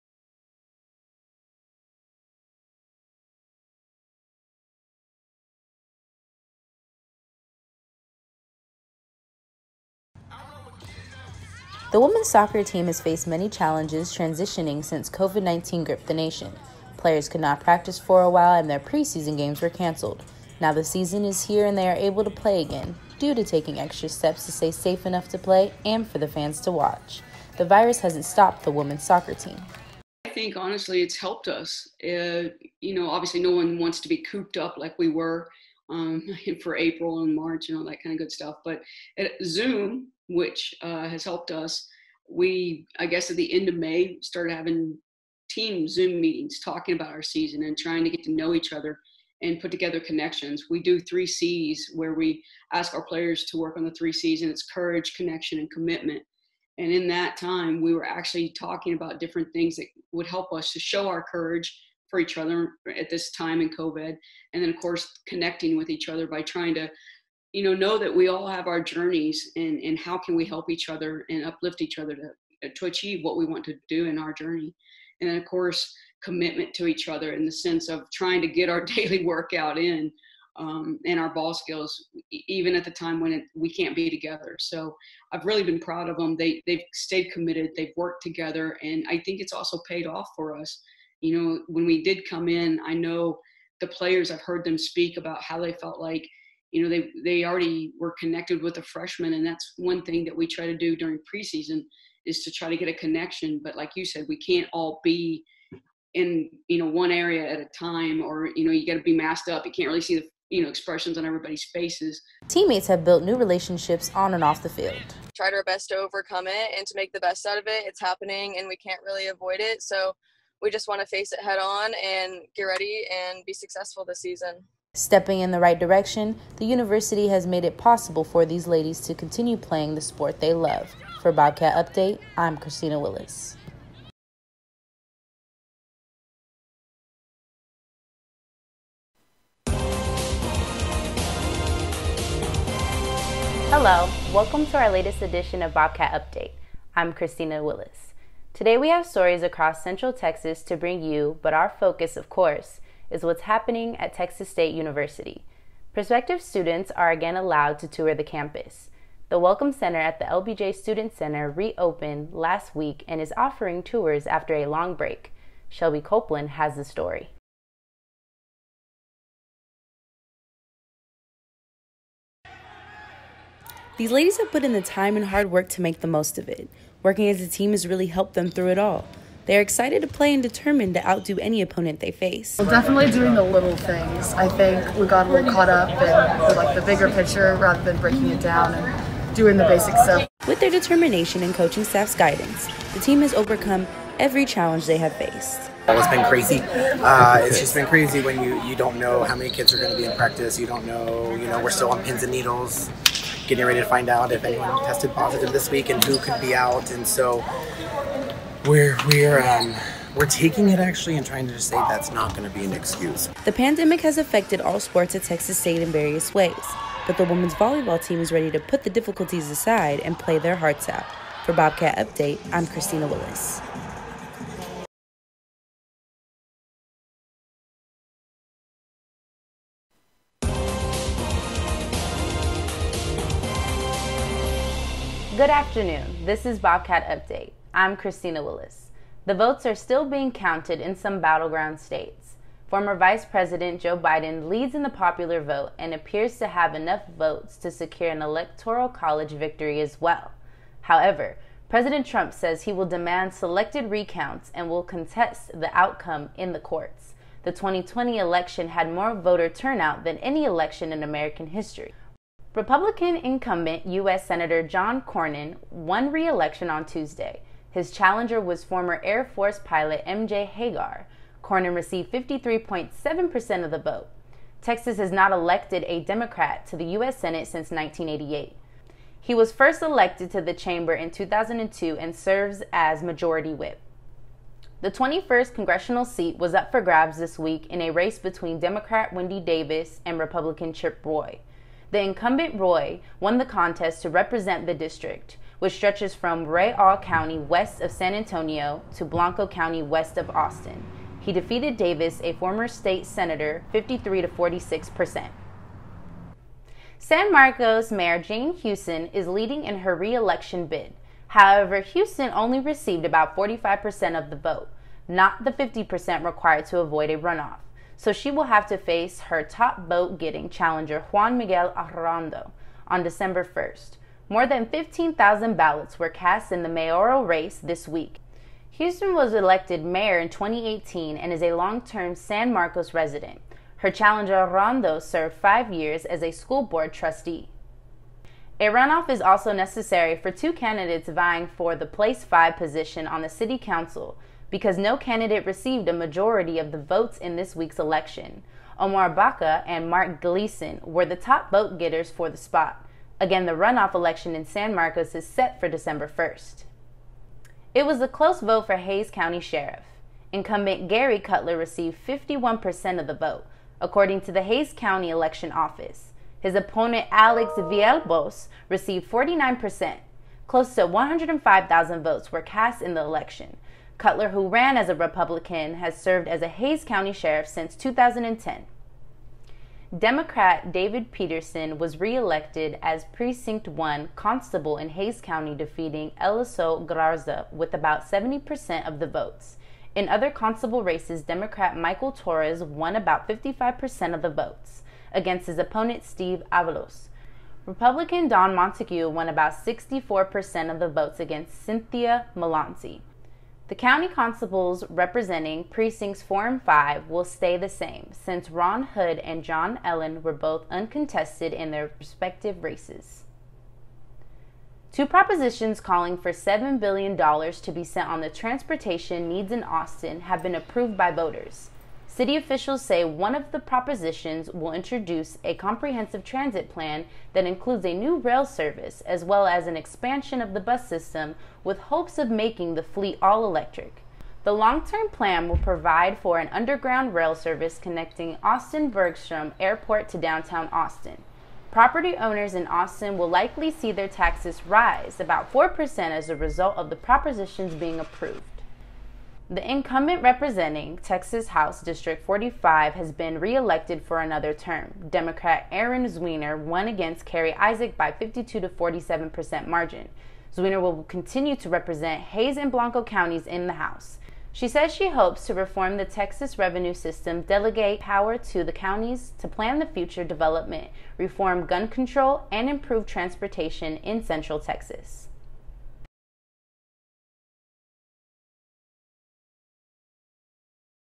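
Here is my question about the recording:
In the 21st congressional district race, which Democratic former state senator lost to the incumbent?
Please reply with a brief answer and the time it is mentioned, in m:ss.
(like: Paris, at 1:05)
Wendy Davis, at 4:49.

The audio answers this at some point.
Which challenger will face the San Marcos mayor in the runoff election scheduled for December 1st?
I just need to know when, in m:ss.
5:21.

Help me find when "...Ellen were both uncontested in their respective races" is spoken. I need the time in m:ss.
6:49.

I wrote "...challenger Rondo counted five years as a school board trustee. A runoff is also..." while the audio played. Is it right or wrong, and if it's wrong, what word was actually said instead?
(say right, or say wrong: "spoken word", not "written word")
wrong: "served", not "counted".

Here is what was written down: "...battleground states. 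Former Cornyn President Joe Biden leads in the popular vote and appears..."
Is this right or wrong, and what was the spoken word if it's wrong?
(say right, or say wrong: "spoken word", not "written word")
wrong: "Vice", not "Cornyn".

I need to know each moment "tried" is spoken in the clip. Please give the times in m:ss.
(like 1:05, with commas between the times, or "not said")
1:55.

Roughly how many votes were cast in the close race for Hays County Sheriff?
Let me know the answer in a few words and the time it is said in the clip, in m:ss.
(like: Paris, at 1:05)
105,000, at 6:10.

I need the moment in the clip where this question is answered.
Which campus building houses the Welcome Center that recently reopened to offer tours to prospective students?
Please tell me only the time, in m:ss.
2:40.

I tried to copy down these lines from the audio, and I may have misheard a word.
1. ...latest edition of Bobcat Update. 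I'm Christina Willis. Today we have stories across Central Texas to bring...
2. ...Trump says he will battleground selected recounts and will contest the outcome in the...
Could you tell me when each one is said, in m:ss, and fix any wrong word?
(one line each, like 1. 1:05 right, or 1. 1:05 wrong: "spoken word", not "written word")
1. 2:24 right
2. 4:12 wrong: "demand", not "battleground".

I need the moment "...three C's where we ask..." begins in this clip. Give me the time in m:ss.
0:50.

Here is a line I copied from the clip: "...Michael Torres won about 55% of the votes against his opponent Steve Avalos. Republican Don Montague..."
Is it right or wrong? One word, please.
right.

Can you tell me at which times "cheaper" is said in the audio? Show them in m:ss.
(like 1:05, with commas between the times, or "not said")
not said.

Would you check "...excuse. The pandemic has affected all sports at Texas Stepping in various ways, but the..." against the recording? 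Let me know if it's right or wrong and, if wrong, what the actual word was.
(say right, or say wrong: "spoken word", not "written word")
wrong: "State", not "Stepping".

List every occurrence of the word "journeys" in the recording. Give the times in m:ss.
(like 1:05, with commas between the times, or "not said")
1:08, 1:14.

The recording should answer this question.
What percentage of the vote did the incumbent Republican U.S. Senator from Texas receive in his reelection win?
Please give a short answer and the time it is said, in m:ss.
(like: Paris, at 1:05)
53.7%, at 4:32.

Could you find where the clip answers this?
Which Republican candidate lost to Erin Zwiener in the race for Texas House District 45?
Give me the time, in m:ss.
7:37.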